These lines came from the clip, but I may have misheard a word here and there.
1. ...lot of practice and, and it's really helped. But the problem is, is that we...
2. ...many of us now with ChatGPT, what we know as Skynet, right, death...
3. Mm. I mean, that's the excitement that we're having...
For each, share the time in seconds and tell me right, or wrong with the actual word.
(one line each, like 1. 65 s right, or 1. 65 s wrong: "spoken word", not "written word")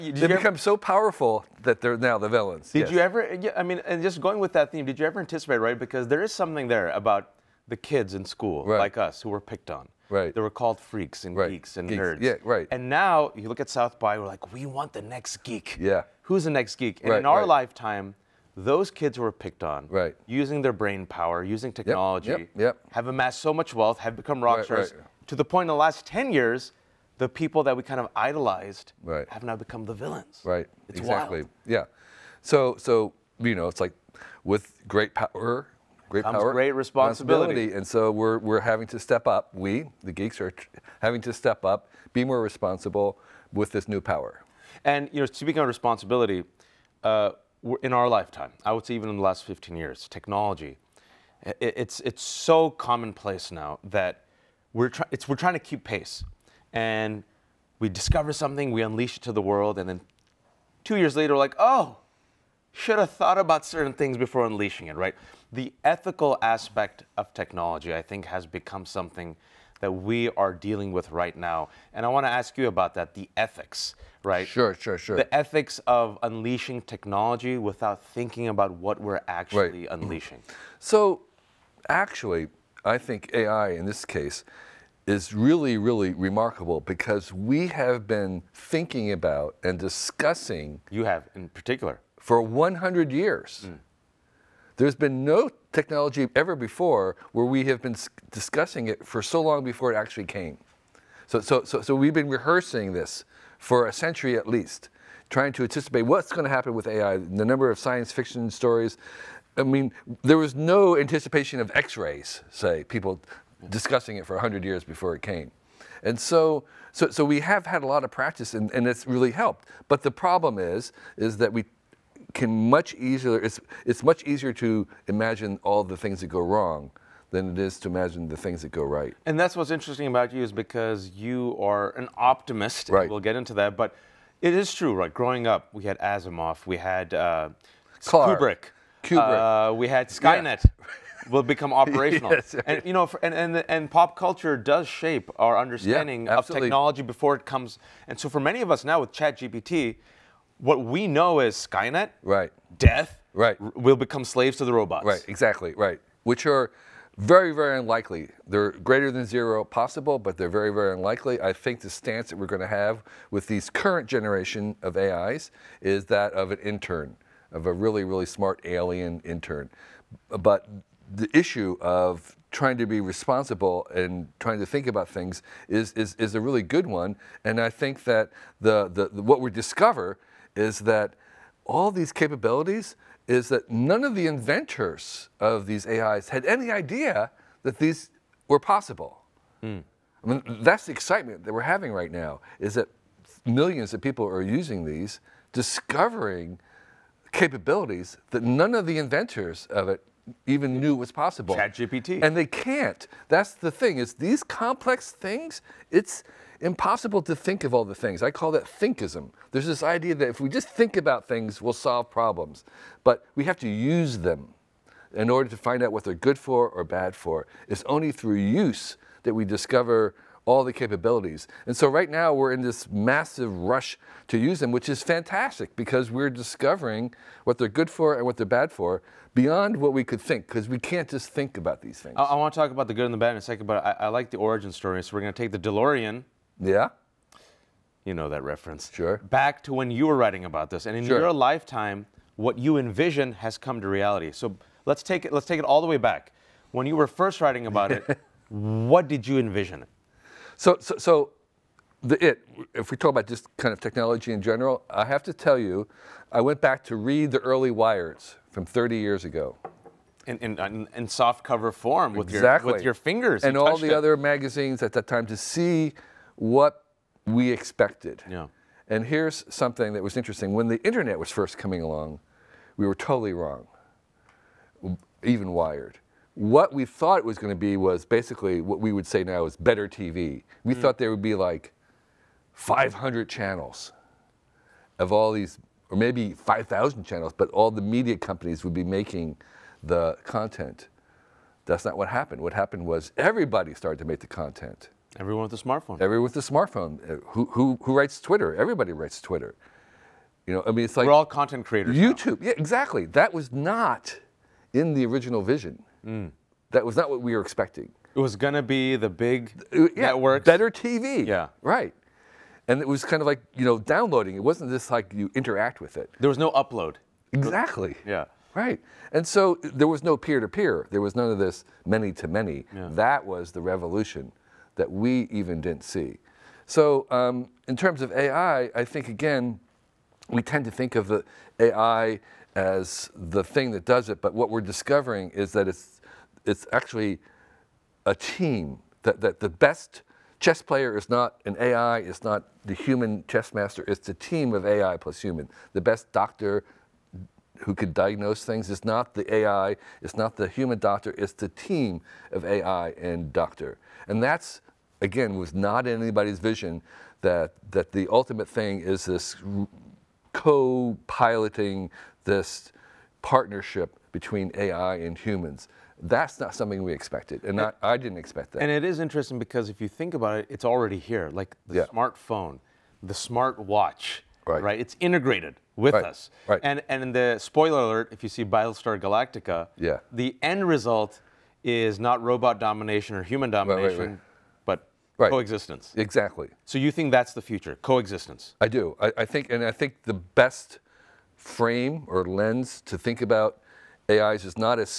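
1. 117 s right
2. 148 s right
3. 189 s right.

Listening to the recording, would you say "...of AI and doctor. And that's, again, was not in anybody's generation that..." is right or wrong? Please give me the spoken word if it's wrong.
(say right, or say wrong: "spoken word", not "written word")
wrong: "vision", not "generation".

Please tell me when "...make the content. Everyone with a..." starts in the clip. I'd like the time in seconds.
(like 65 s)
294 s.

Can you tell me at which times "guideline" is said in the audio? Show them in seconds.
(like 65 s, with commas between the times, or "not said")
not said.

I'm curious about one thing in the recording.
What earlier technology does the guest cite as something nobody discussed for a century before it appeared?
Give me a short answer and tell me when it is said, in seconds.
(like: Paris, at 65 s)
X-rays, at 111 s.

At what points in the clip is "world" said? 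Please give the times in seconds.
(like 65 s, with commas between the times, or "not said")
59 s.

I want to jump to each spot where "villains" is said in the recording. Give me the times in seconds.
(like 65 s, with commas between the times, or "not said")
2 s, 29 s.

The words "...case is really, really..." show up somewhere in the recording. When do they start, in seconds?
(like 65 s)
84 s.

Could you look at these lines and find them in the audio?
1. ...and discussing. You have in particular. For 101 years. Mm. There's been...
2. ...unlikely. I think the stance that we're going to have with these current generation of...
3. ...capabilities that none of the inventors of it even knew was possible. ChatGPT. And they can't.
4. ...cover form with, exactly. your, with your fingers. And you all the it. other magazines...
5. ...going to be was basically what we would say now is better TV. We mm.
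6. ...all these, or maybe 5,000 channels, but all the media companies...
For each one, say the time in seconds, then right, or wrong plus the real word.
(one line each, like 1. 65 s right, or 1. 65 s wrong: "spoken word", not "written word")
1. 89 s wrong: "100", not "101"
2. 160 s right
3. 197 s right
4. 261 s right
5. 277 s right
6. 285 s right.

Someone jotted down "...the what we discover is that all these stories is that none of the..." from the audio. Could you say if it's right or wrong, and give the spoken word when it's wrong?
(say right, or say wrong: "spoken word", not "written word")
wrong: "capabilities", not "stories".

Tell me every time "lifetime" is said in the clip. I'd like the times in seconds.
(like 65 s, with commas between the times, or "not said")
17 s, 48 s, 241 s.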